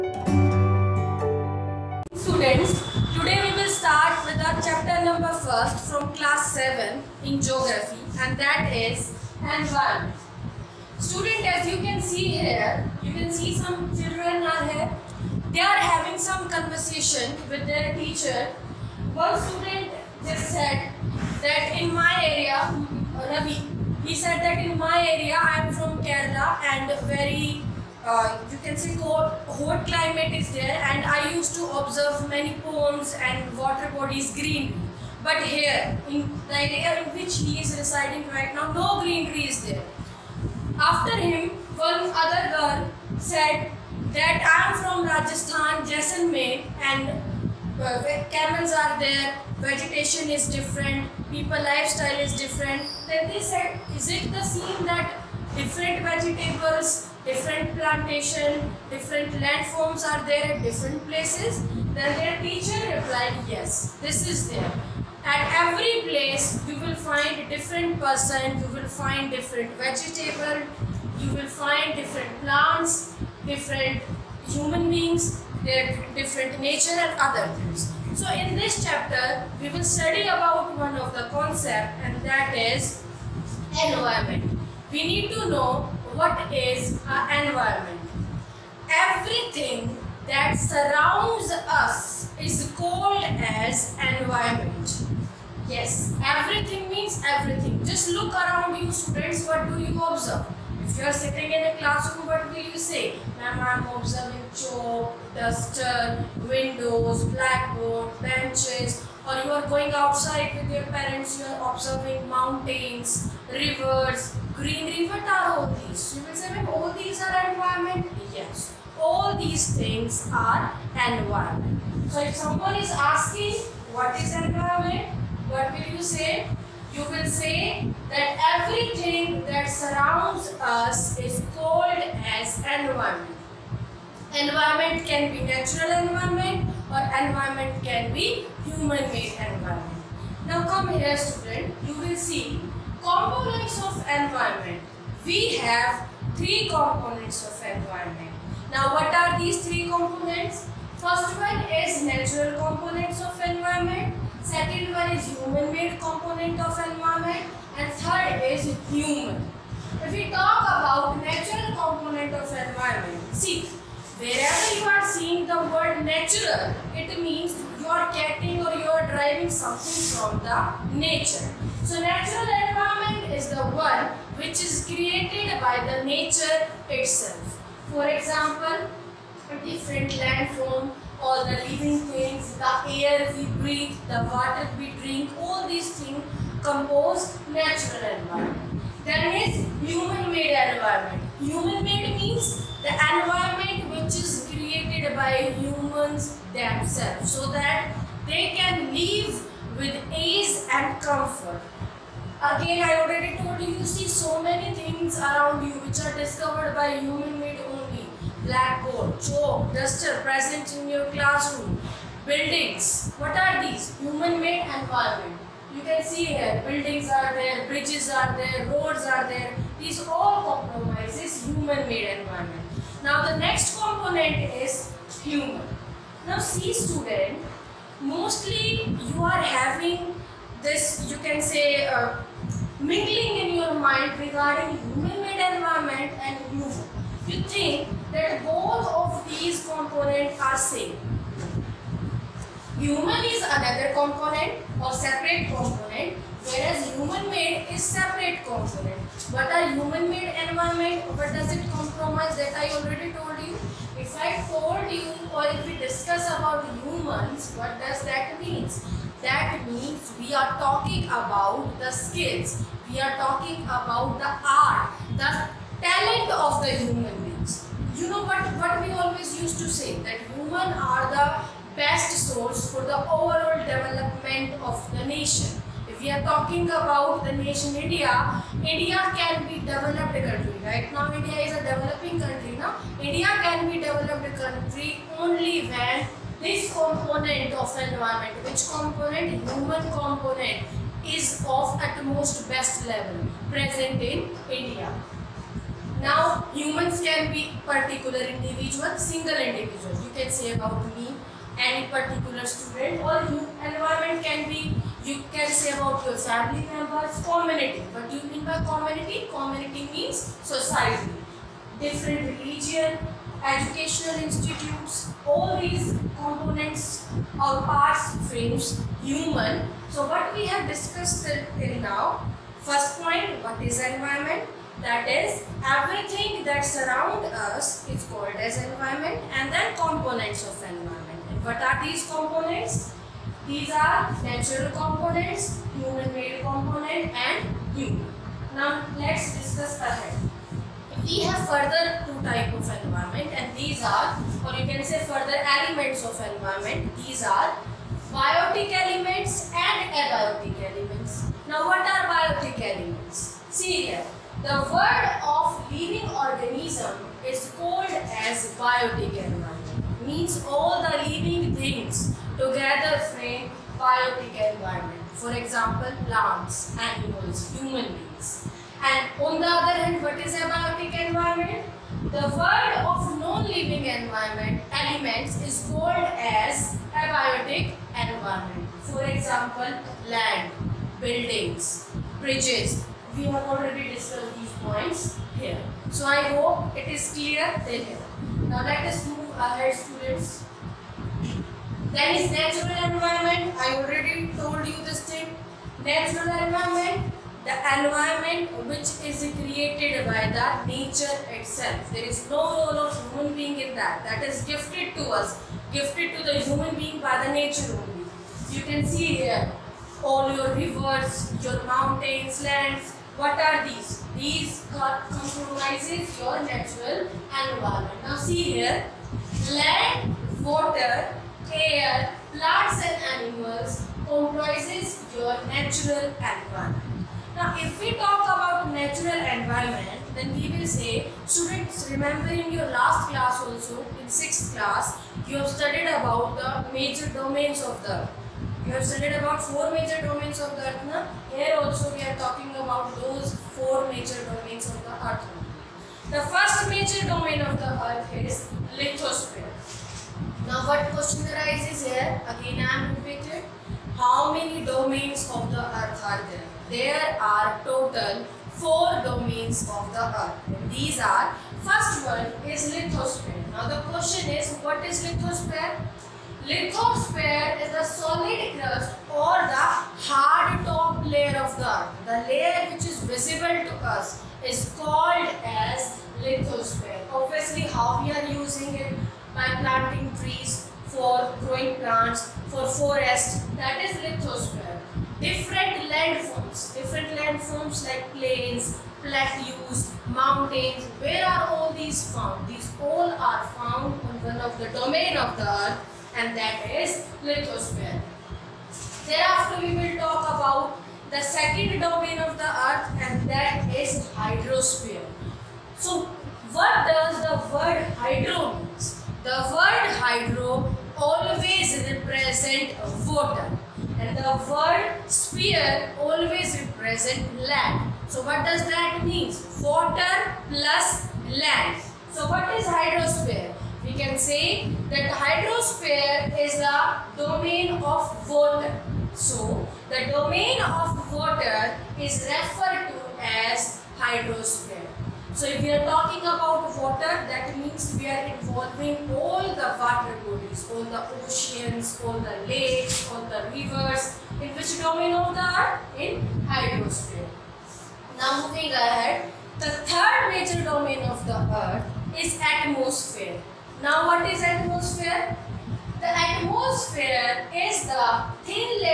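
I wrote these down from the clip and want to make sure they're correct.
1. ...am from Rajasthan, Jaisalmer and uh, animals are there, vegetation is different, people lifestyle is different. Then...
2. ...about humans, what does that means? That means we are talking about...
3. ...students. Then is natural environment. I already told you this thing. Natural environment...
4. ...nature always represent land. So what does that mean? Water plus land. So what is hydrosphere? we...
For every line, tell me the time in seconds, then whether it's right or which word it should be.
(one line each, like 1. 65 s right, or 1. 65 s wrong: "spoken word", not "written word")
1. 44 s wrong: "camels", not "animals"
2. 256 s right
3. 389 s right
4. 515 s wrong: "sphere", not "nature".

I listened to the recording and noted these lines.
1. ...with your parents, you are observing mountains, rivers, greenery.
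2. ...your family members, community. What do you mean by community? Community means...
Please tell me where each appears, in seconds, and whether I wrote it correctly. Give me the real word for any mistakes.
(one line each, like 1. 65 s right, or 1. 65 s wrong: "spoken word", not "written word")
1. 110 s right
2. 306 s right.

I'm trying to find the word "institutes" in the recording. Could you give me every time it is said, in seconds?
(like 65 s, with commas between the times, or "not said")
314 s.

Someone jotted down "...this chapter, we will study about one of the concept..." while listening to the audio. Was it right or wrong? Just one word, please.
right.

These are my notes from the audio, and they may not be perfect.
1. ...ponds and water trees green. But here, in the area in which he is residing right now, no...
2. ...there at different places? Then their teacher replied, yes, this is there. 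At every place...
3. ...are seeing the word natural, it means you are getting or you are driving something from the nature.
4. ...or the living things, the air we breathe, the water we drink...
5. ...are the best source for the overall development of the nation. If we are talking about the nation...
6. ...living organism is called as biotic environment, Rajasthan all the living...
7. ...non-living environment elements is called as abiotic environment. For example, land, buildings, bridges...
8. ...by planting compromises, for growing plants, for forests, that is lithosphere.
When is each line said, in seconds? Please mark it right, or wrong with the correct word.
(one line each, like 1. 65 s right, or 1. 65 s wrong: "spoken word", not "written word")
1. 32 s wrong: "bodies", not "trees"
2. 60 s right
3. 164 s right
4. 181 s right
5. 270 s right
6. 355 s wrong: "Means", not "Rajasthan"
7. 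373 s right
8. 479 s wrong: "trees", not "compromises".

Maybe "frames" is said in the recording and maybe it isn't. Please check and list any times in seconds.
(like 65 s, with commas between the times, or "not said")
318 s, 363 s.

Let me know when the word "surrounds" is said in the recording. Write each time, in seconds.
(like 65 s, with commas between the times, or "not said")
90 s, 129 s, 326 s.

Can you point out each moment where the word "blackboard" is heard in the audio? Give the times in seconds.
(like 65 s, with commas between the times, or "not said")
107 s, 208 s.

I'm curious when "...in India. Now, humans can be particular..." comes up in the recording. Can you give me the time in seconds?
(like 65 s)
294 s.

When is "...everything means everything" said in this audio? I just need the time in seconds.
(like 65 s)
96 s.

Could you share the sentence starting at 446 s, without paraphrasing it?
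The first major domain of the earth is lithosphere.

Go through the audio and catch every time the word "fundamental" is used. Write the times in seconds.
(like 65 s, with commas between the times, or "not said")
not said.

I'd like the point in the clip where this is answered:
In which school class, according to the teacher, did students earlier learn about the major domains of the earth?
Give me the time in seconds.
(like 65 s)
434 s.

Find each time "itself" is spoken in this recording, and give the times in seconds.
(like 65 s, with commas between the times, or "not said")
176 s, 401 s.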